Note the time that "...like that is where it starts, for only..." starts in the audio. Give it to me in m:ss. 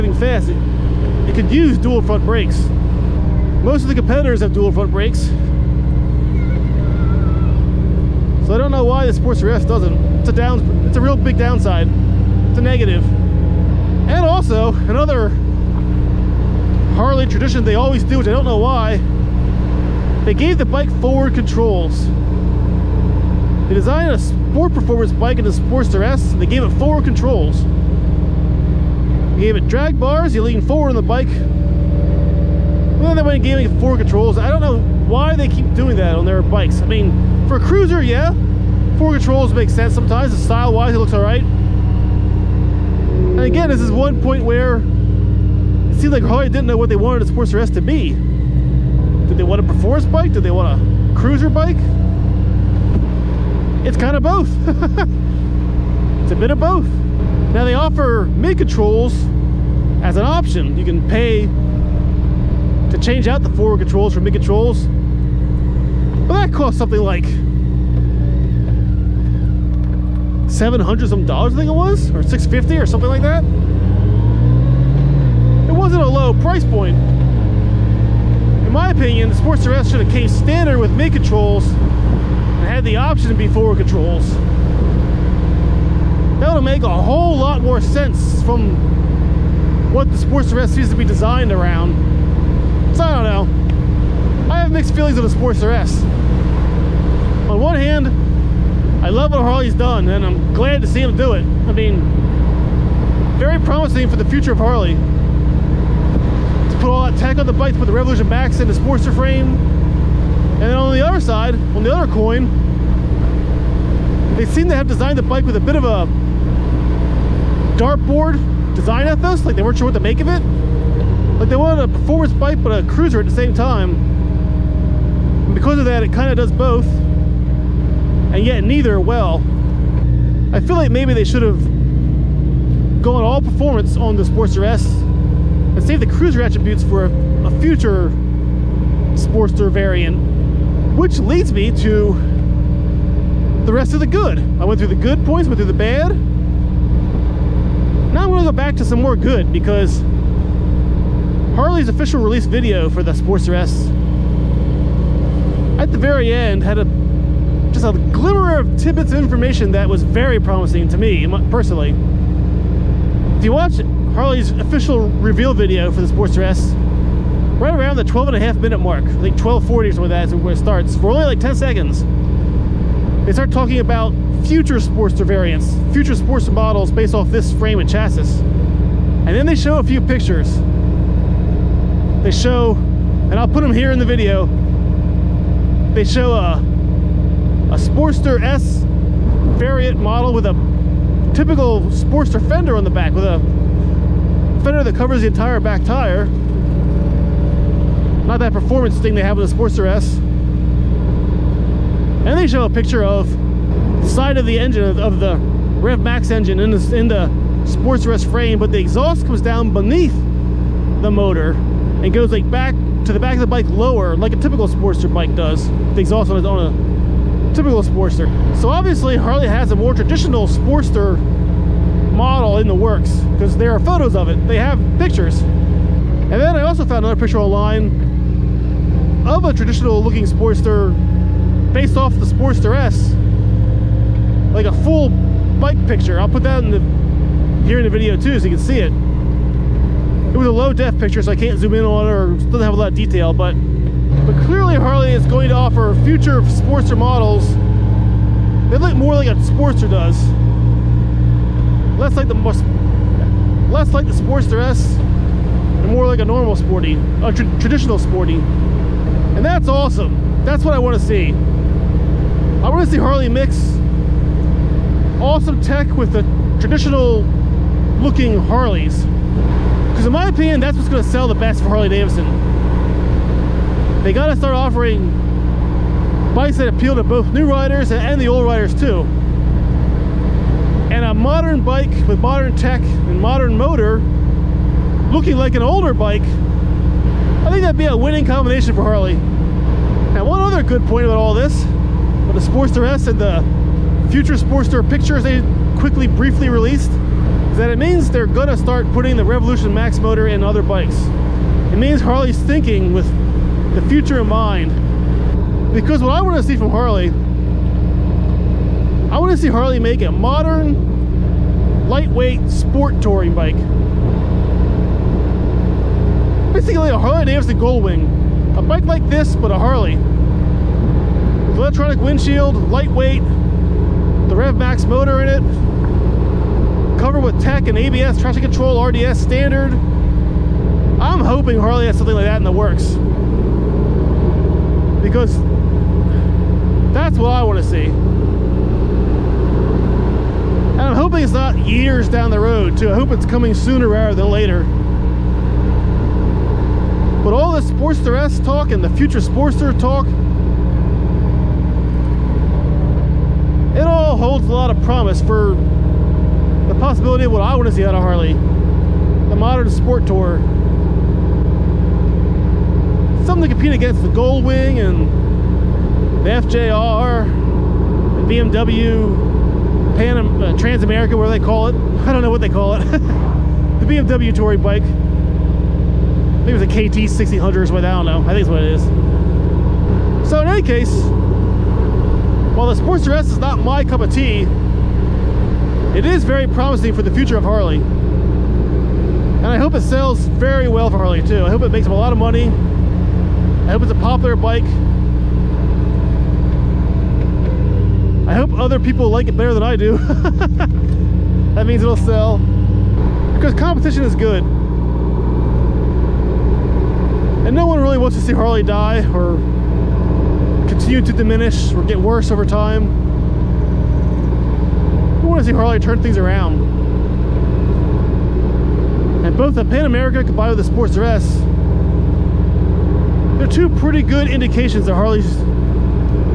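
2:50.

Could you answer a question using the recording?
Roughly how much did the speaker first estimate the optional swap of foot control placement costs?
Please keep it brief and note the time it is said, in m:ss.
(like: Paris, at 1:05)
$700, at 1:10.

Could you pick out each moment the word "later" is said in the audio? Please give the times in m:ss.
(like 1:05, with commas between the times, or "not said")
5:44.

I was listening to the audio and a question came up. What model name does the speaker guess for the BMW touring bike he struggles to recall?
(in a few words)
KT 1600.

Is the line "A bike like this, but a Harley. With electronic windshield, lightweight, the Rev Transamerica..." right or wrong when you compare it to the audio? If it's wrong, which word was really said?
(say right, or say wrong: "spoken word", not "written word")
wrong: "Max", not "Transamerica".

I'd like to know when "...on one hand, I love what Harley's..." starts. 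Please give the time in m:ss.
1:37.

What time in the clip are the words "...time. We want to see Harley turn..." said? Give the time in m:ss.
6:52.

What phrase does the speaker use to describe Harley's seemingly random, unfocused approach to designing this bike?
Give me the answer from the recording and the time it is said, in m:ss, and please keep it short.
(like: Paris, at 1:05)
dartboard design ethos, at 1:57.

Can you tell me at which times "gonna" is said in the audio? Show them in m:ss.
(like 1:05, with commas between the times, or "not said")
2:28, 4:58.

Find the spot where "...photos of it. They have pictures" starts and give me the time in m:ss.
3:43.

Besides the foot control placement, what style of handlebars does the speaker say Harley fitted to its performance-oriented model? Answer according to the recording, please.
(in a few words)
drag bars.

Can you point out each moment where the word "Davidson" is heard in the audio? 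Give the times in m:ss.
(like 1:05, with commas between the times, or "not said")
4:31, 5:17.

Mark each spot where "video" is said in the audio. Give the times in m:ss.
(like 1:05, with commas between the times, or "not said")
2:32, 2:45, 3:04, 3:57.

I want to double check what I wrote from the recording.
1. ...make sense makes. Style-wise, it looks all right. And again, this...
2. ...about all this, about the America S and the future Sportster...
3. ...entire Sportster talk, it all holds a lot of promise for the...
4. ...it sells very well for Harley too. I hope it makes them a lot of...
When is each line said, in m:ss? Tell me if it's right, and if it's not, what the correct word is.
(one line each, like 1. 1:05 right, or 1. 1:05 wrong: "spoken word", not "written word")
1. 0:39 wrong: "sometimes", not "makes"
2. 4:51 wrong: "Sportster", not "America"
3. 5:48 wrong: "future", not "entire"
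4. 6:29 right.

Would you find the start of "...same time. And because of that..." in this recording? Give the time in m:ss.
2:03.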